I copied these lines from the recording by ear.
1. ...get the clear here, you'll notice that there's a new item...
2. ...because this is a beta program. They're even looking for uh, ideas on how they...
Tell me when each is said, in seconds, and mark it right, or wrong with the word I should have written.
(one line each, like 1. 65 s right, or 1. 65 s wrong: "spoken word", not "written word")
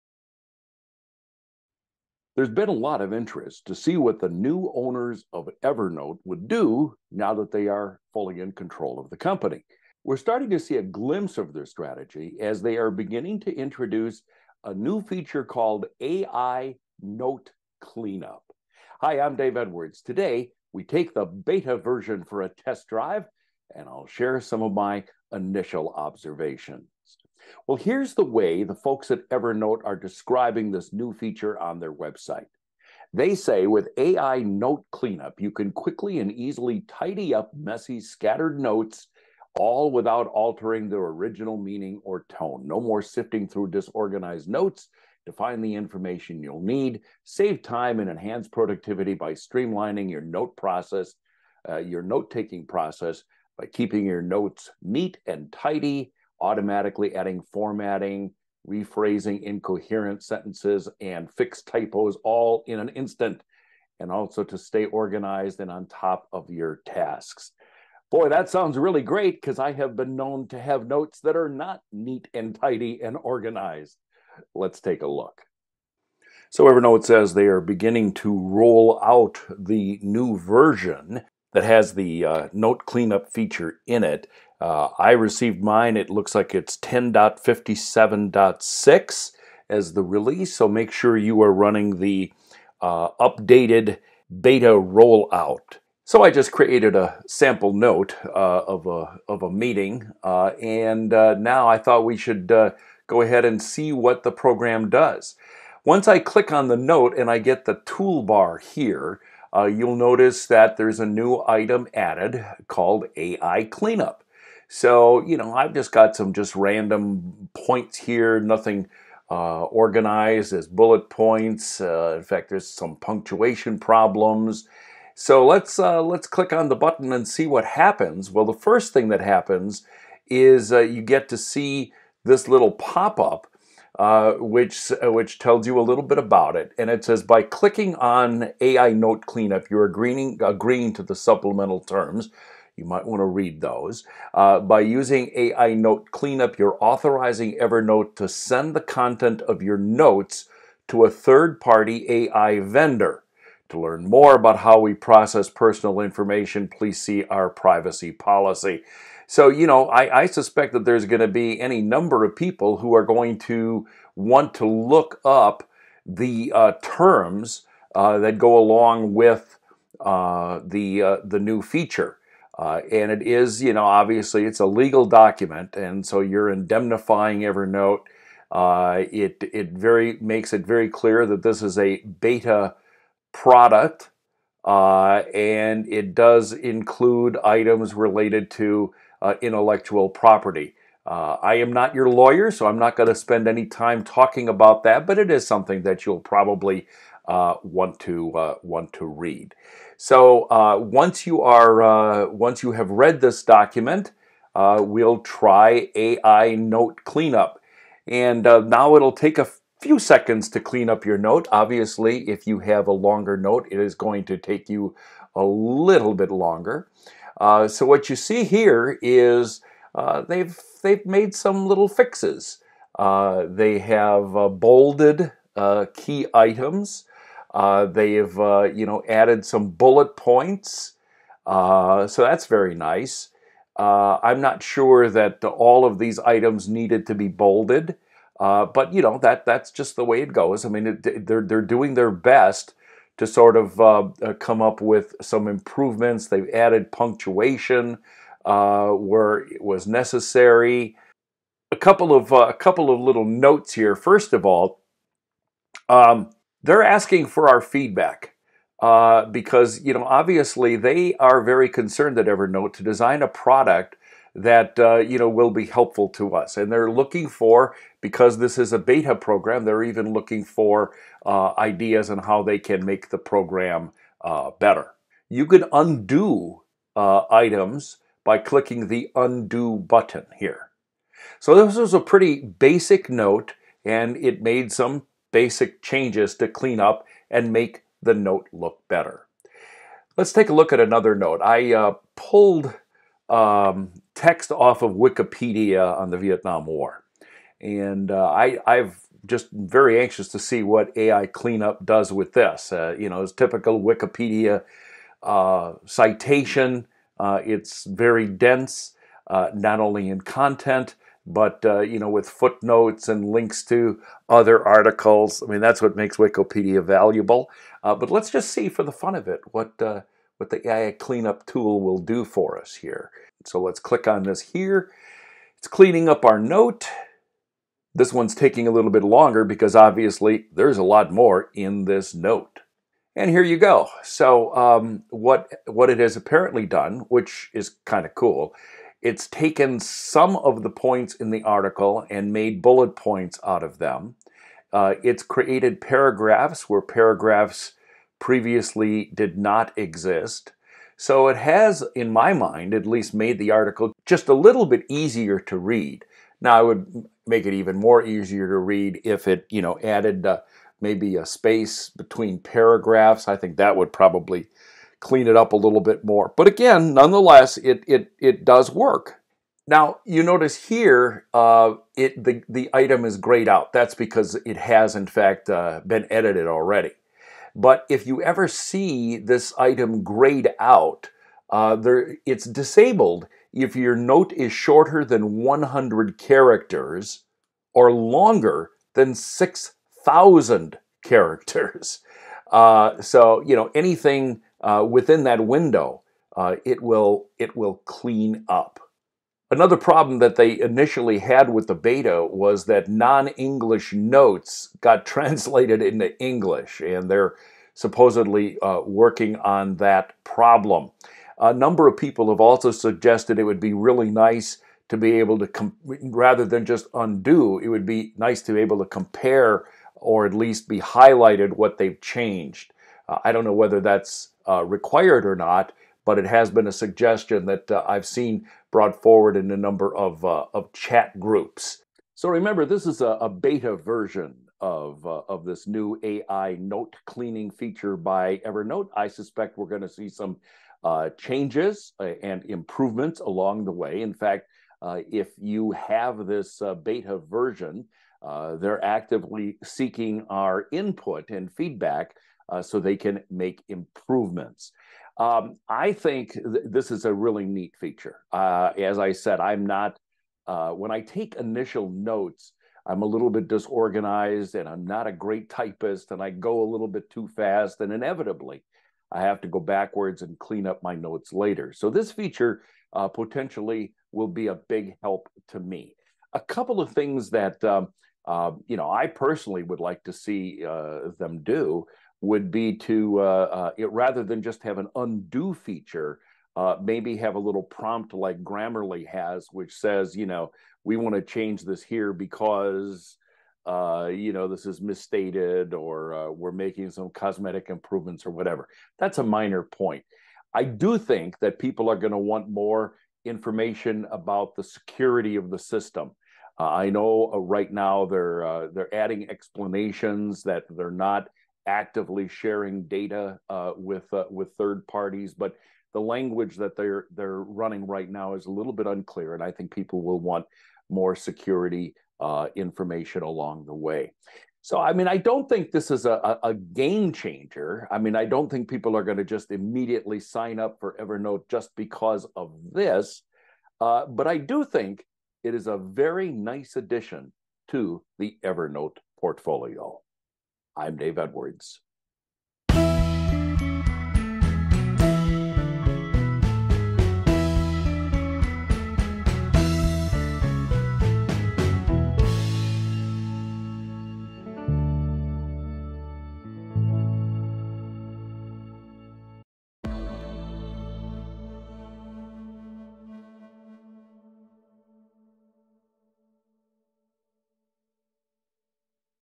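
1. 107 s wrong: "toolbar", not "clear"
2. 267 s right.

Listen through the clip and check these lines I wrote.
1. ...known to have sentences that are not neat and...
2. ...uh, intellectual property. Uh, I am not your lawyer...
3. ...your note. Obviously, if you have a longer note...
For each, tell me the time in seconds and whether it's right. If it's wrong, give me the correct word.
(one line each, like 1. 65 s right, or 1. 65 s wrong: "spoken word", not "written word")
1. 70 s wrong: "notes", not "sentences"
2. 189 s right
3. 211 s right.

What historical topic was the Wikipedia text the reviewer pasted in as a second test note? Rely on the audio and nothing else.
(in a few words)
Vietnam War.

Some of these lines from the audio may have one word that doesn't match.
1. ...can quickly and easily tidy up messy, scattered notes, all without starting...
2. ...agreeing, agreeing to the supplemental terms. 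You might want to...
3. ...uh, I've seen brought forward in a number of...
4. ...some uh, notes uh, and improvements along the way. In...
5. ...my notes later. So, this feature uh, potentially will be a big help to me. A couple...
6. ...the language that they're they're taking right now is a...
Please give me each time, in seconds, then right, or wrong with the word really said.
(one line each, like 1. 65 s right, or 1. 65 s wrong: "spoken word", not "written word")
1. 35 s wrong: "altering", not "starting"
2. 139 s right
3. 427 s right
4. 440 s wrong: "changes", not "notes"
5. 470 s right
6. 515 s wrong: "running", not "taking".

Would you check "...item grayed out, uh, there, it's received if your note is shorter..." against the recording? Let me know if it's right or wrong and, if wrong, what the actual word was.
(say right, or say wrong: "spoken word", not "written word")
wrong: "disabled", not "received".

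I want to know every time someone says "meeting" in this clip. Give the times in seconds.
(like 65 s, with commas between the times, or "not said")
99 s.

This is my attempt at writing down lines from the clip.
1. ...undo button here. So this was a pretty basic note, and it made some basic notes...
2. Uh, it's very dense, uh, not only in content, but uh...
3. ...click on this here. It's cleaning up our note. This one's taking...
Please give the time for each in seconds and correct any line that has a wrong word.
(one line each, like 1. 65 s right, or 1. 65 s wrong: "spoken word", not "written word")
1. 279 s wrong: "changes", not "notes"
2. 307 s right
3. 323 s right.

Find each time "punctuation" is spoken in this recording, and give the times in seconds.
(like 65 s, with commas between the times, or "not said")
122 s, 246 s.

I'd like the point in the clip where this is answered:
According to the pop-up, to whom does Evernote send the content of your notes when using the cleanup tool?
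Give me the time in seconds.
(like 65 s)
151 s.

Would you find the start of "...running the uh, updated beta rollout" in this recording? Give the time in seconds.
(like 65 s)
91 s.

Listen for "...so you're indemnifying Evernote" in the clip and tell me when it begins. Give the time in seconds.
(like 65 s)
176 s.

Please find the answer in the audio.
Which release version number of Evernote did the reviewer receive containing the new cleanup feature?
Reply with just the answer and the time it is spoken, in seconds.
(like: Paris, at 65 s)
10.57.6, at 86 s.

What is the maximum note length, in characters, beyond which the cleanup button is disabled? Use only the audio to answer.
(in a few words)
6,000.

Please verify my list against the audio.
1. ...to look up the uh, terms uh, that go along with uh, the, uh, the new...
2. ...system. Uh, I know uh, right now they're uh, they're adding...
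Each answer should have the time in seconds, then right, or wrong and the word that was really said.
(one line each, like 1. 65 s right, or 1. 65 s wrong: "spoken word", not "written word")
1. 164 s right
2. 505 s right.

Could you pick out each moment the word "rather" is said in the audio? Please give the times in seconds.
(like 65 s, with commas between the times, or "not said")
415 s, 483 s.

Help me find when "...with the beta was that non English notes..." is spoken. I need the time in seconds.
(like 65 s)
401 s.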